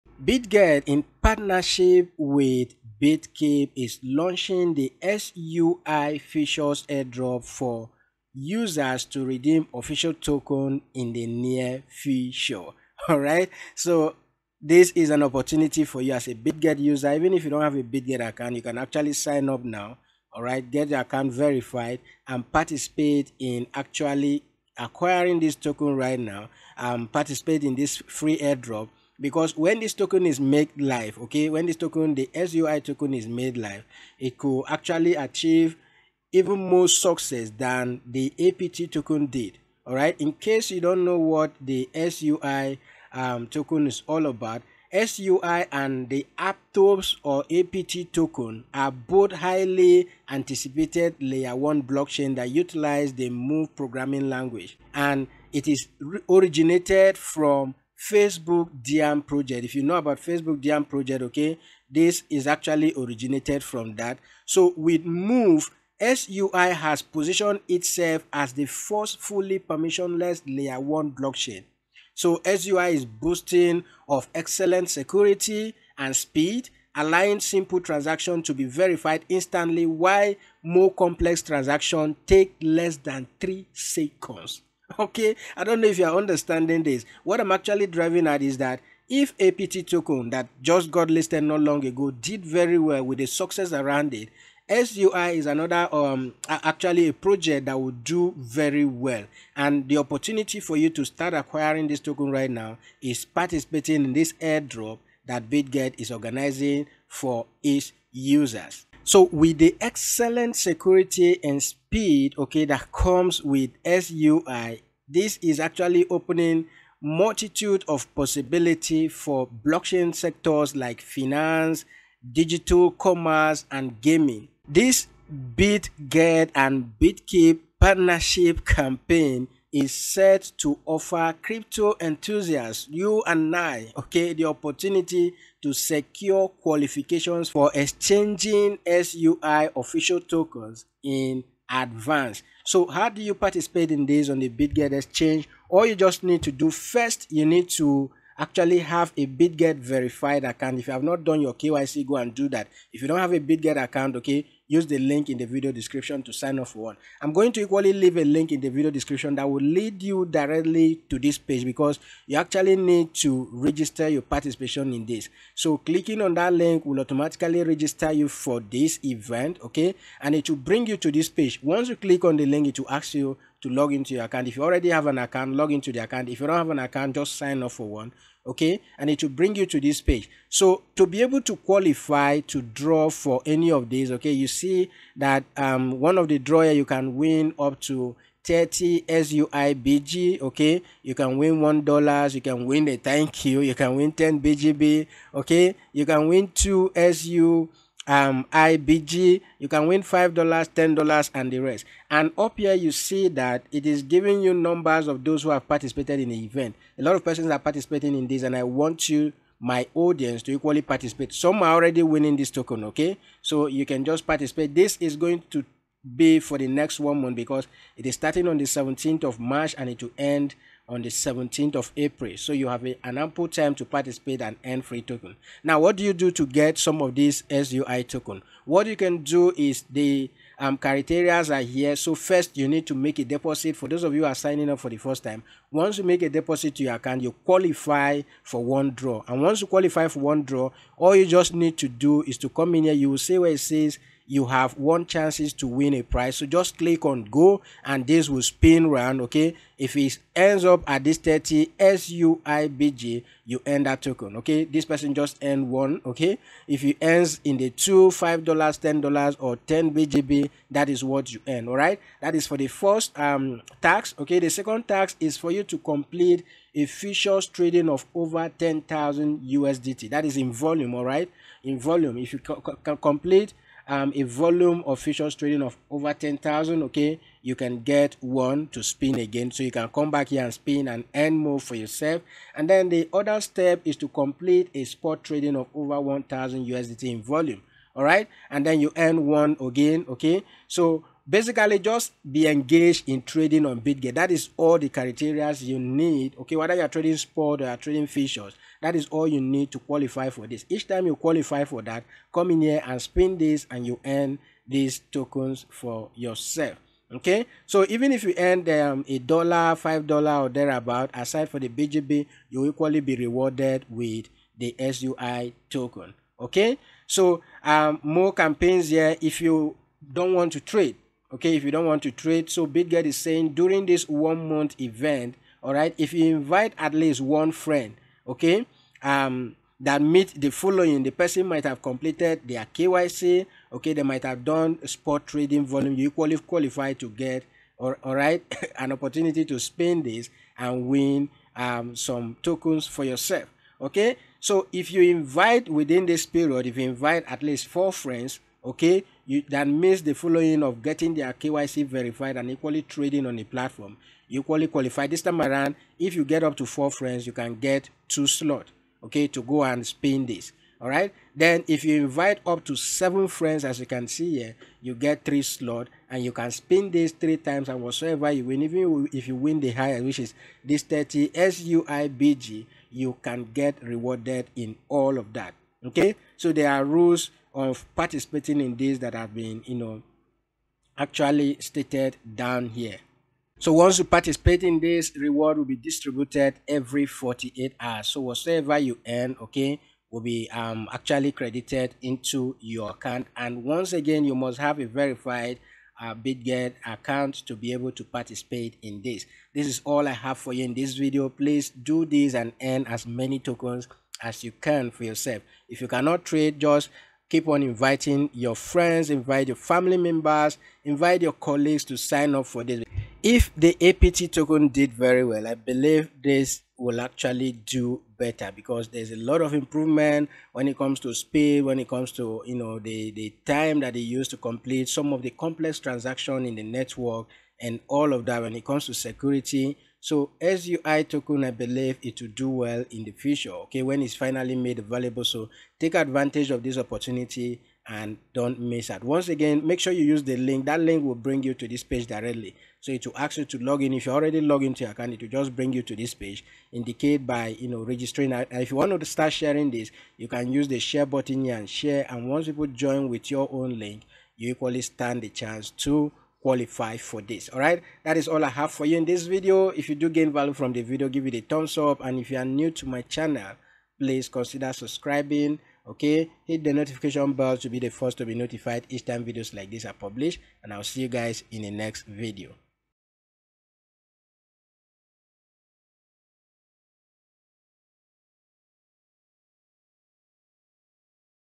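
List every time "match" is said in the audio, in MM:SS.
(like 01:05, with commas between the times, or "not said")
not said.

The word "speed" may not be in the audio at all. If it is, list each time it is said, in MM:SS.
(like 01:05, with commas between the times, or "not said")
01:16, 01:51, 07:01.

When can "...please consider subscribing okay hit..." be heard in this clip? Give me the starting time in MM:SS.
07:43.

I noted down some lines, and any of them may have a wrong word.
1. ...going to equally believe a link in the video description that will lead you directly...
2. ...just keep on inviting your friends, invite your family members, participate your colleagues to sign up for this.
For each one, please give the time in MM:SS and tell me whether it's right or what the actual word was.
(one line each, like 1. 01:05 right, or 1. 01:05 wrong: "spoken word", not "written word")
1. 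02:37 wrong: "leave", not "believe"
2. 06:46 wrong: "invite", not "participate".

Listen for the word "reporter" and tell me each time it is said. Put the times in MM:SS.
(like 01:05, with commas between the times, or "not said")
not said.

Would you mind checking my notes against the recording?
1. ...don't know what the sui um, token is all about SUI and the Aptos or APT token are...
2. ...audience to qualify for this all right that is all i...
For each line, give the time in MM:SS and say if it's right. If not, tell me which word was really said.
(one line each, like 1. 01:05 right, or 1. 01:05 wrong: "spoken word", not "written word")
1. 00:40 right
2. 07:35 wrong: "chance", not "audience".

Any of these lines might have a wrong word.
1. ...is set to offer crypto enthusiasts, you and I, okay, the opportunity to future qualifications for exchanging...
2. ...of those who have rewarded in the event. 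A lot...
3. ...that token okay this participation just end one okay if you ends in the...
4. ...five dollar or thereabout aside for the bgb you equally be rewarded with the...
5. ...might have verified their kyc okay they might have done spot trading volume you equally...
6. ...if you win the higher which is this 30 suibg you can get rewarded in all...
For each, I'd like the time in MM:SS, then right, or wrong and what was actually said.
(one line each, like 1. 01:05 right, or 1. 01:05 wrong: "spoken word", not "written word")
1. 02:09 wrong: "secure", not "future"
2. 03:25 wrong: "participated", not "rewarded"
3. 04:13 wrong: "person", not "participation"
4. 05:09 right
5. 05:31 wrong: "completed", not "verified"
6. 06:09 right.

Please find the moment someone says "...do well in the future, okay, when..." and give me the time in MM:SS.
07:12.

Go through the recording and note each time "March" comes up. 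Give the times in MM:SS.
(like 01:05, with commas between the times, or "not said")
03:39.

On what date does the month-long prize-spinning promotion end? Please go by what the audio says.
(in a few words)
17th of April.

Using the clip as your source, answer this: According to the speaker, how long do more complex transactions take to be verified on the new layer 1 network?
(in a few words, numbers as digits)
less than 3 seconds.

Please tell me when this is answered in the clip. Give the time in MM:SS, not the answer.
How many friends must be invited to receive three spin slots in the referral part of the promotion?
06:02.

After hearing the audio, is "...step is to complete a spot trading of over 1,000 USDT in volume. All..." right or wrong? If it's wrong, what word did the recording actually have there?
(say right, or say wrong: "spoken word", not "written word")
right.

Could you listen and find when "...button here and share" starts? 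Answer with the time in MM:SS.
07:31.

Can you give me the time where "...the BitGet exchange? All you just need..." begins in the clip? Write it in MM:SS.
02:24.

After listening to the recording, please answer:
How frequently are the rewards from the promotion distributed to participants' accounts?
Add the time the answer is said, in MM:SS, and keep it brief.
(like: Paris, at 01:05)
every 48 hours, at 06:26.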